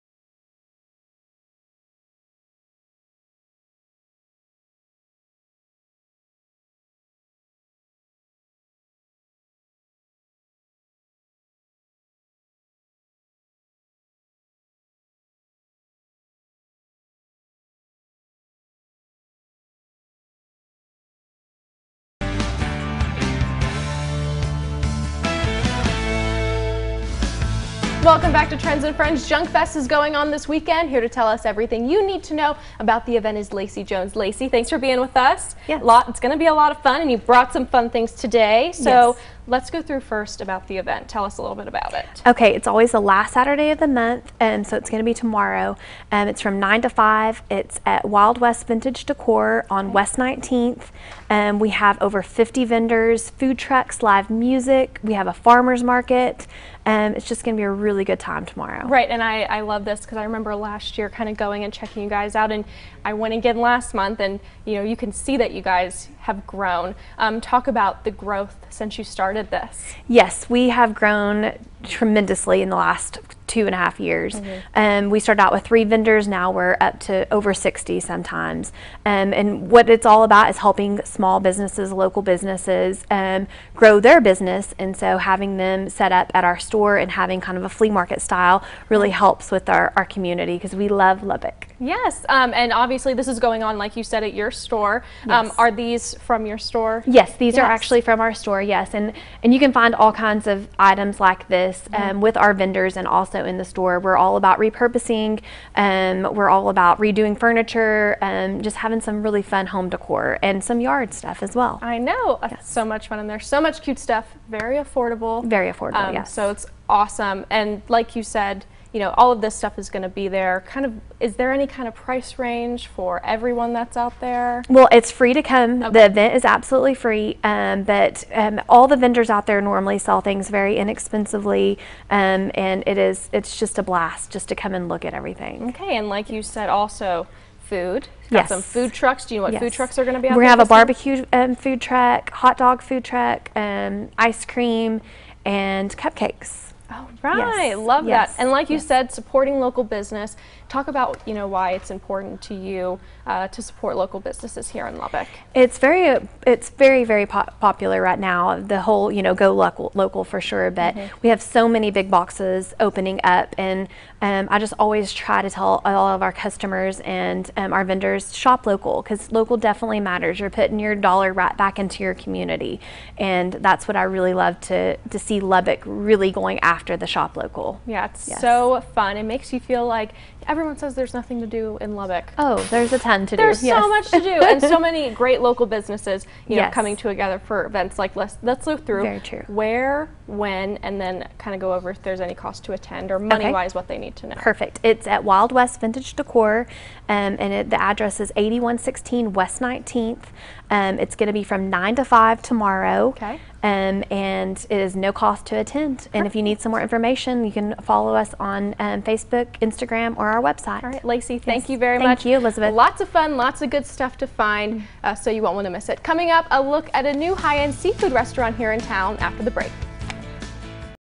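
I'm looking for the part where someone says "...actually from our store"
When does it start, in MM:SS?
01:37.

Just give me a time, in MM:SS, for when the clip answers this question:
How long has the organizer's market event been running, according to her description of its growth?
01:13.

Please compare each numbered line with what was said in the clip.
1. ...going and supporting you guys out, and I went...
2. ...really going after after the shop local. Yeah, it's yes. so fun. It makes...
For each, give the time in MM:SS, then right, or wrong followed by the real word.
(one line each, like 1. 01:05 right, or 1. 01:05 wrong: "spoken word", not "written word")
1. 01:01 wrong: "checking", not "supporting"
2. 02:55 right.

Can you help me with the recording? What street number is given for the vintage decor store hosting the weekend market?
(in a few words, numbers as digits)
8116.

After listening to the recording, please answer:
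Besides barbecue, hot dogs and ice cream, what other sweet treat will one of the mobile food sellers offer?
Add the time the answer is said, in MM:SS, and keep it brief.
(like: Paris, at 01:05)
Cupcakes, at 02:25.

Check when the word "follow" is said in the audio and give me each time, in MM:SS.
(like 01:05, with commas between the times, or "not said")
03:27.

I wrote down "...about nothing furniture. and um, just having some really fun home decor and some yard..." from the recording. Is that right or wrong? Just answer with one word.
wrong.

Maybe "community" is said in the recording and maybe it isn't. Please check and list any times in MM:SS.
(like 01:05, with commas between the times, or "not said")
01:30, 02:52.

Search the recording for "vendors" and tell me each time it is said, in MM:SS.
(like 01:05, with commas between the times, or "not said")
00:52, 01:15, 01:42, 02:08, 02:47.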